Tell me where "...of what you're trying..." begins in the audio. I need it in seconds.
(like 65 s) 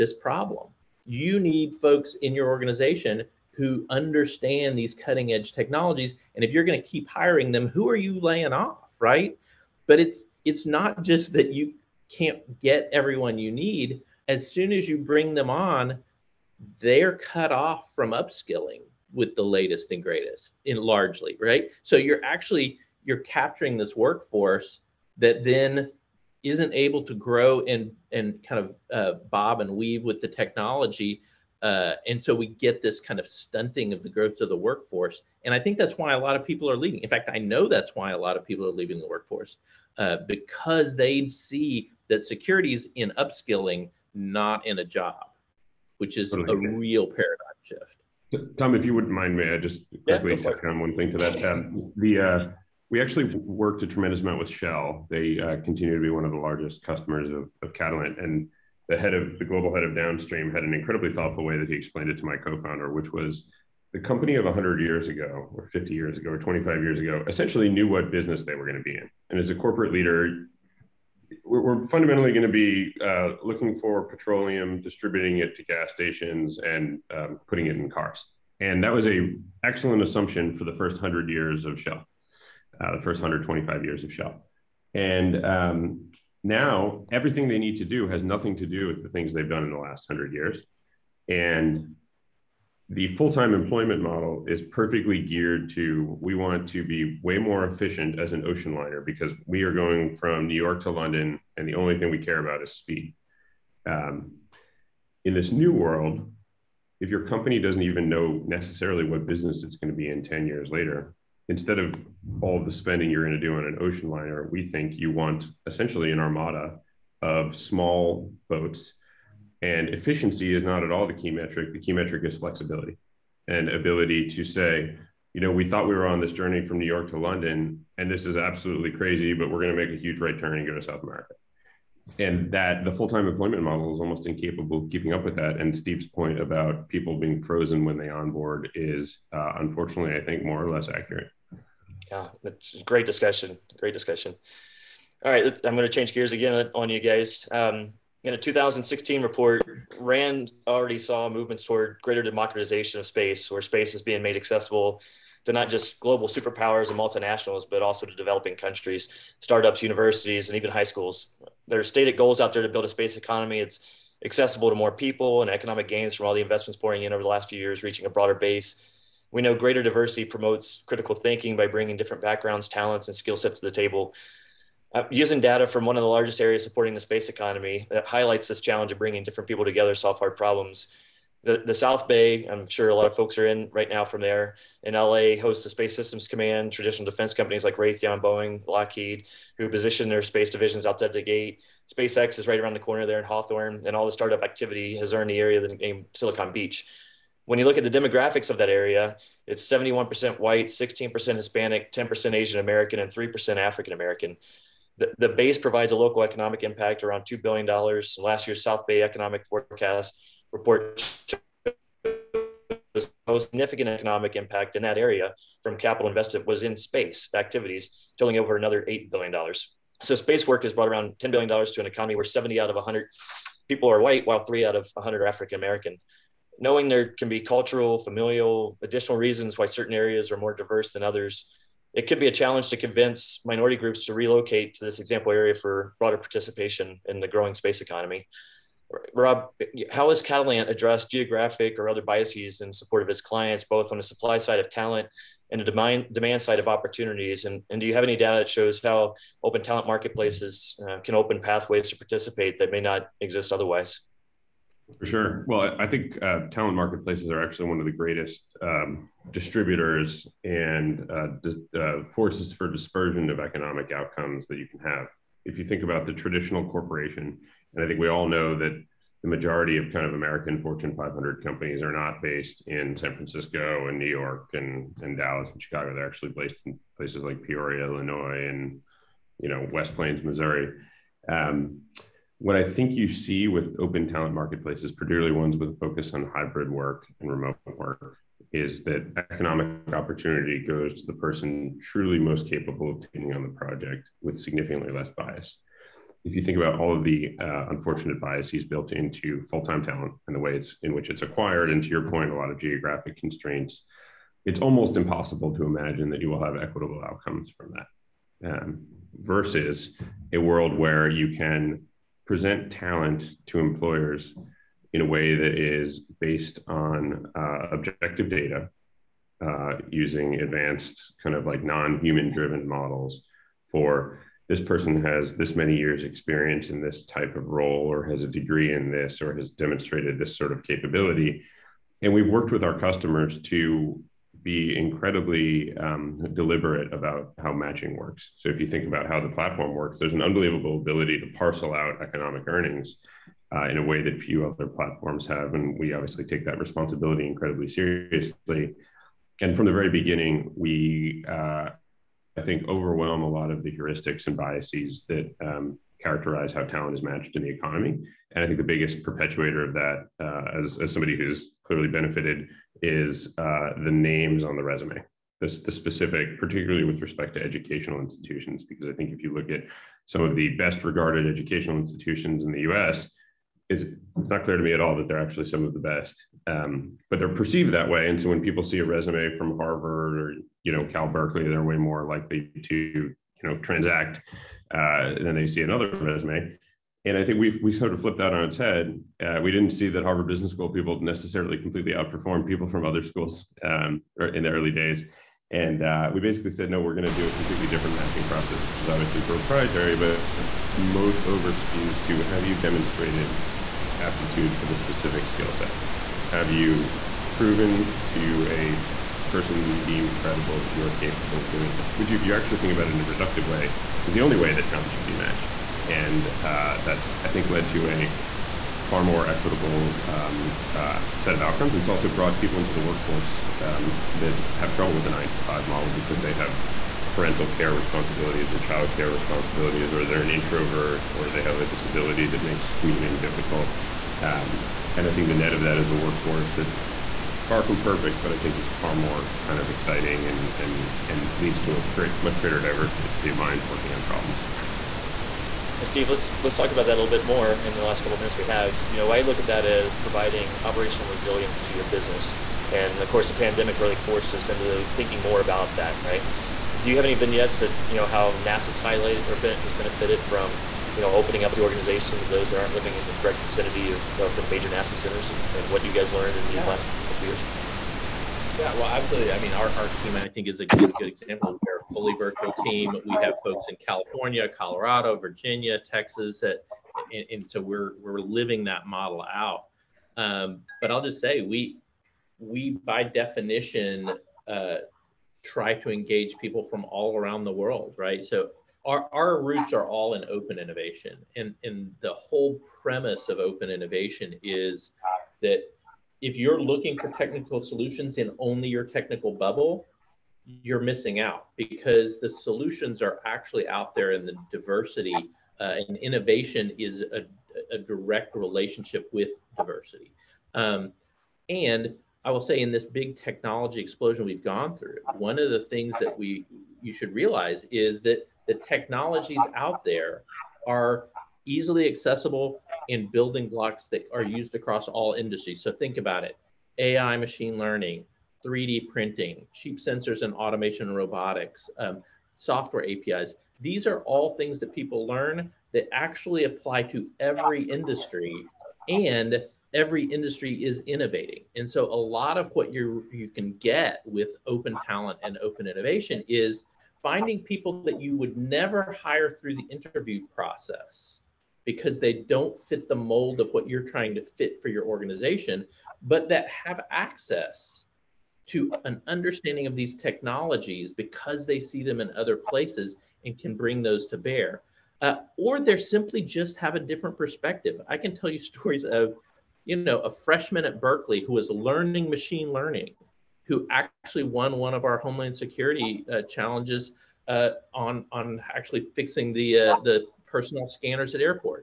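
553 s.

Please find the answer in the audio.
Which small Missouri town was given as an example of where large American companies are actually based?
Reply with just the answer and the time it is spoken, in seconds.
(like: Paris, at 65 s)
West Plains, at 279 s.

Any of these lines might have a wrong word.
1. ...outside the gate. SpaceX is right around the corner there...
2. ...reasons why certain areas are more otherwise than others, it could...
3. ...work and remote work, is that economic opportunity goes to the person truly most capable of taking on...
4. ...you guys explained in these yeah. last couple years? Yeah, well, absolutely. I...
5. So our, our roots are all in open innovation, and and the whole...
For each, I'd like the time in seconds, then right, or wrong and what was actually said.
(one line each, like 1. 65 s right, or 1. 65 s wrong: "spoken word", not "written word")
1. 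190 s right
2. 229 s wrong: "diverse", not "otherwise"
3. 286 s right
4. 465 s wrong: "learned", not "explained"
5. 488 s right.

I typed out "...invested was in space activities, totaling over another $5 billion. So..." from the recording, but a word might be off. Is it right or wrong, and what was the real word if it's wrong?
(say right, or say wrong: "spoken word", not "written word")
wrong: "8", not "5".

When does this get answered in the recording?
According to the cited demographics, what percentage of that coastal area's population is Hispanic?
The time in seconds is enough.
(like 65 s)
200 s.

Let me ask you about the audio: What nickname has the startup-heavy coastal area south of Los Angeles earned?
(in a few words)
Silicon Beach.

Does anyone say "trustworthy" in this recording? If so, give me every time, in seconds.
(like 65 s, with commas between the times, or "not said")
not said.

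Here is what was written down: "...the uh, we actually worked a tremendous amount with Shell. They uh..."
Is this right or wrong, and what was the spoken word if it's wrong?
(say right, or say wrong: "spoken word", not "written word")
right.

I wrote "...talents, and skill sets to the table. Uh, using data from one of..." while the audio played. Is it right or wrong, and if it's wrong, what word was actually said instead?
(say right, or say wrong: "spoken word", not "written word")
right.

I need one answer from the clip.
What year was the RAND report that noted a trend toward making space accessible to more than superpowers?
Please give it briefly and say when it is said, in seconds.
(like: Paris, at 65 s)
2016, at 148 s.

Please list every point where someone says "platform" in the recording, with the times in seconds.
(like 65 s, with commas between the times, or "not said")
339 s, 344 s.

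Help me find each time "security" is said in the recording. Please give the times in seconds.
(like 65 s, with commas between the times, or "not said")
42 s, 575 s.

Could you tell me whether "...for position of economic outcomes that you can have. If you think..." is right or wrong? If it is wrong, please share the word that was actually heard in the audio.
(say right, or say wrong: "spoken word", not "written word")
wrong: "dispersion", not "position".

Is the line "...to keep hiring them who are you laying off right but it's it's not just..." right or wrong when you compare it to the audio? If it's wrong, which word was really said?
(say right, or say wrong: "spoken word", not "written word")
right.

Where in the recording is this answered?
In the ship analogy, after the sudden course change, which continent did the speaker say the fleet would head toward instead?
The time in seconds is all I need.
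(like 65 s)
130 s.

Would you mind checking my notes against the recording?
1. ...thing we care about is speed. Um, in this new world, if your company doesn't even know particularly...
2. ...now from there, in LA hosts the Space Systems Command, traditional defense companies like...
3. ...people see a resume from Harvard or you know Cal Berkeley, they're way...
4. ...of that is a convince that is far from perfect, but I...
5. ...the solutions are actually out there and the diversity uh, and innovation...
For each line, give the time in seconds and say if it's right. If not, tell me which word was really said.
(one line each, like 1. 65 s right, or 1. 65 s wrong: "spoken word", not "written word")
1. 101 s wrong: "necessarily", not "particularly"
2. 183 s right
3. 378 s right
4. 435 s wrong: "workforce", not "convince"
5. 502 s right.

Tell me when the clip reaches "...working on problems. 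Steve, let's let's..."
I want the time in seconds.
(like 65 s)
443 s.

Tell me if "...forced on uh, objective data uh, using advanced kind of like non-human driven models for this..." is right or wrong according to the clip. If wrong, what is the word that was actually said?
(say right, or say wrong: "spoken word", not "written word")
wrong: "based", not "forced".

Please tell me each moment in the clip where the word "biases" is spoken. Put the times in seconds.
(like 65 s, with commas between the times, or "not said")
242 s, 298 s, 354 s.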